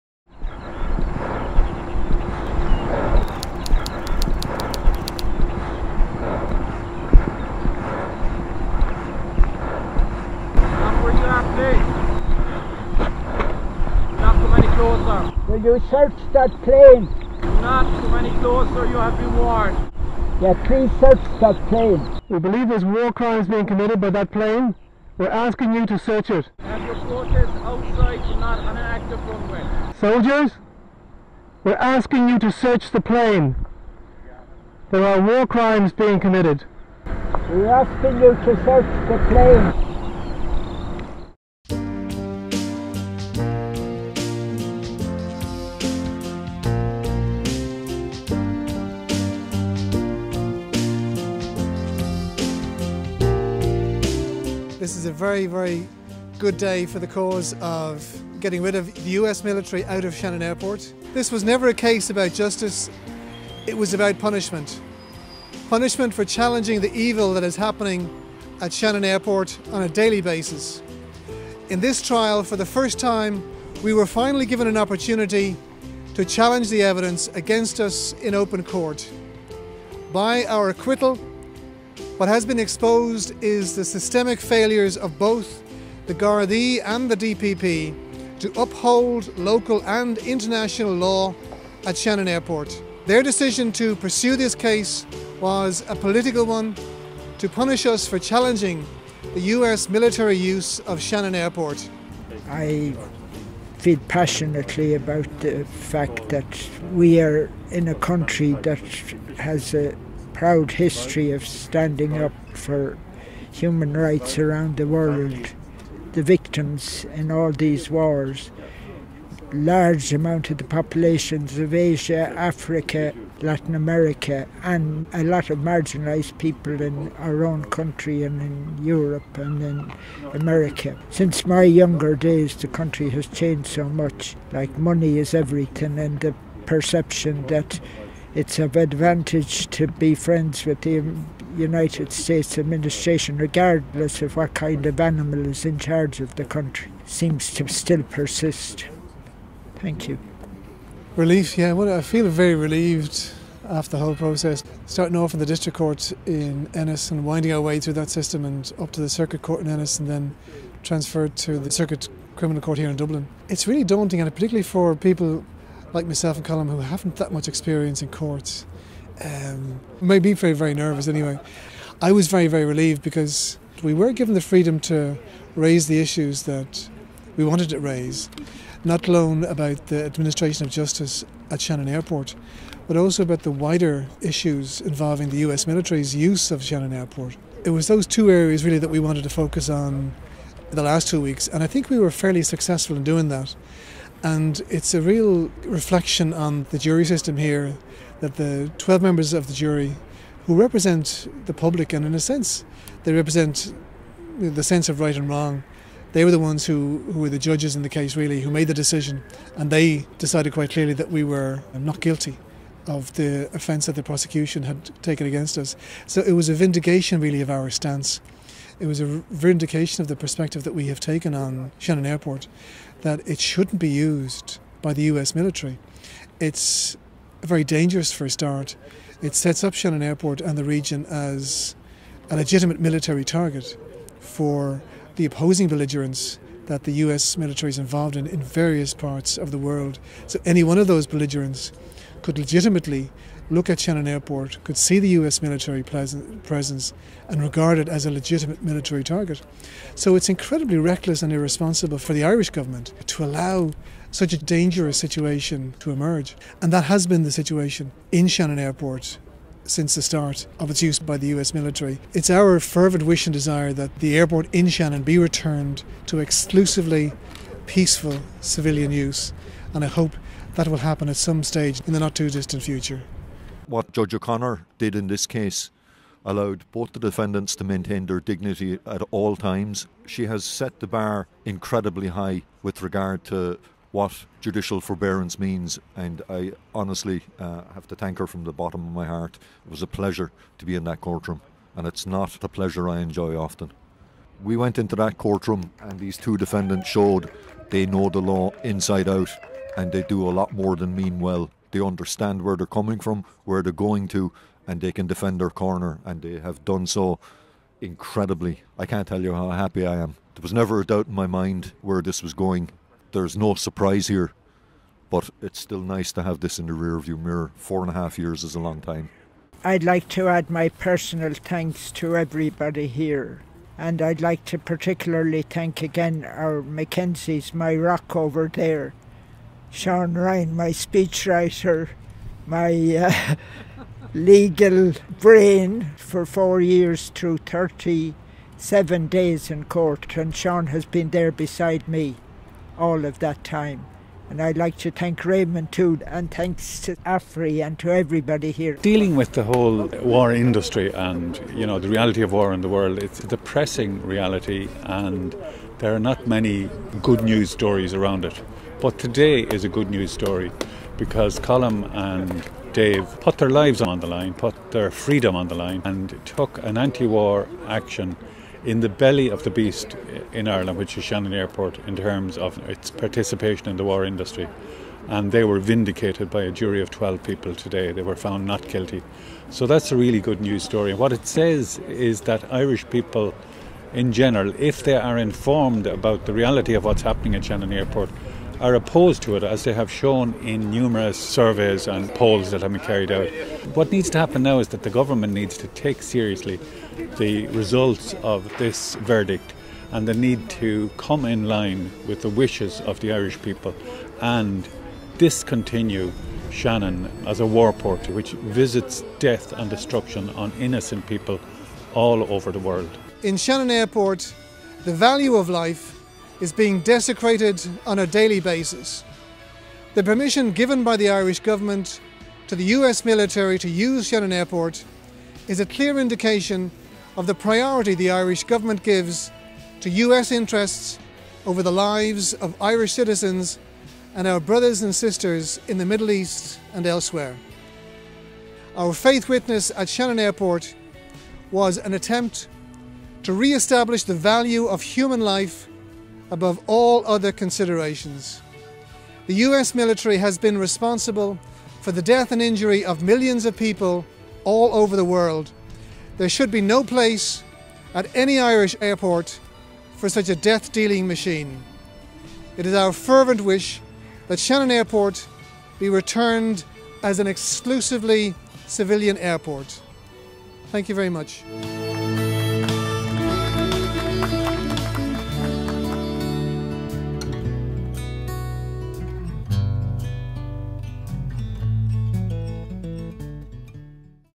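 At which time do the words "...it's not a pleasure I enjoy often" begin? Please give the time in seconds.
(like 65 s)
291 s.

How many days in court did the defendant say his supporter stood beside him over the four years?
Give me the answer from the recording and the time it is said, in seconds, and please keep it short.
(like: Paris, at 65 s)
37, at 337 s.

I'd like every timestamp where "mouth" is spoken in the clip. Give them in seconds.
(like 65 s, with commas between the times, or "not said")
not said.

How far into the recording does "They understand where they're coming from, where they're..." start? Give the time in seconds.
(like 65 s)
301 s.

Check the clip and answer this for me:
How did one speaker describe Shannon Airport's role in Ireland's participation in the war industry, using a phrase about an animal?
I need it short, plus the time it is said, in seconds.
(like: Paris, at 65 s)
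the belly of the beast, at 368 s.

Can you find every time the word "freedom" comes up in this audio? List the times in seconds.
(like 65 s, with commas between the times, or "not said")
174 s, 364 s.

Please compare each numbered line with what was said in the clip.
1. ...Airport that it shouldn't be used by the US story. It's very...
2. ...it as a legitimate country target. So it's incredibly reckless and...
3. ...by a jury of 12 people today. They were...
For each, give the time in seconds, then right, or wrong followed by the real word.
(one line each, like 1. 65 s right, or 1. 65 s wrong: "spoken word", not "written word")
1. 222 s wrong: "military", not "story"
2. 247 s wrong: "military", not "country"
3. 376 s right.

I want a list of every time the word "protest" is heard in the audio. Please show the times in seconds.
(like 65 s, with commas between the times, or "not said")
26 s.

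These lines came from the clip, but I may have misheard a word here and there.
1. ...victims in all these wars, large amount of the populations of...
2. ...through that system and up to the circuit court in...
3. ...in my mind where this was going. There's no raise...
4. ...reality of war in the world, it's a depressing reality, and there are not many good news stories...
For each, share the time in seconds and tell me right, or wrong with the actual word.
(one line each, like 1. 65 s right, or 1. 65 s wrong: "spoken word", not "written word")
1. 116 s right
2. 157 s right
3. 311 s wrong: "surprise", not "raise"
4. 351 s right.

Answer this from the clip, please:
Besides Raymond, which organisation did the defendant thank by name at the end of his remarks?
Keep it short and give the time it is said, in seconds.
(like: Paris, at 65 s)
Afri, at 346 s.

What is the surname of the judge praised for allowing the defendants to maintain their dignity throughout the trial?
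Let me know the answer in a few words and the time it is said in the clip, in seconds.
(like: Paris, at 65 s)
O'Connor, at 274 s.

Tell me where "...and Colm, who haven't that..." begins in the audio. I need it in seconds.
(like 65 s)
166 s.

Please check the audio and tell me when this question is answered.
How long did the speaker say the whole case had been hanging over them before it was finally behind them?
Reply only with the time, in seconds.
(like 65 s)
317 s.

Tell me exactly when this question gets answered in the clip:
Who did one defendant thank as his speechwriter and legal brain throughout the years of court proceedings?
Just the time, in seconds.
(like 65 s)
329 s.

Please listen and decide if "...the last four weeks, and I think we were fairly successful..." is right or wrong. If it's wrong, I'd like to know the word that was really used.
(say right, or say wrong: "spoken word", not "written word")
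wrong: "two", not "four".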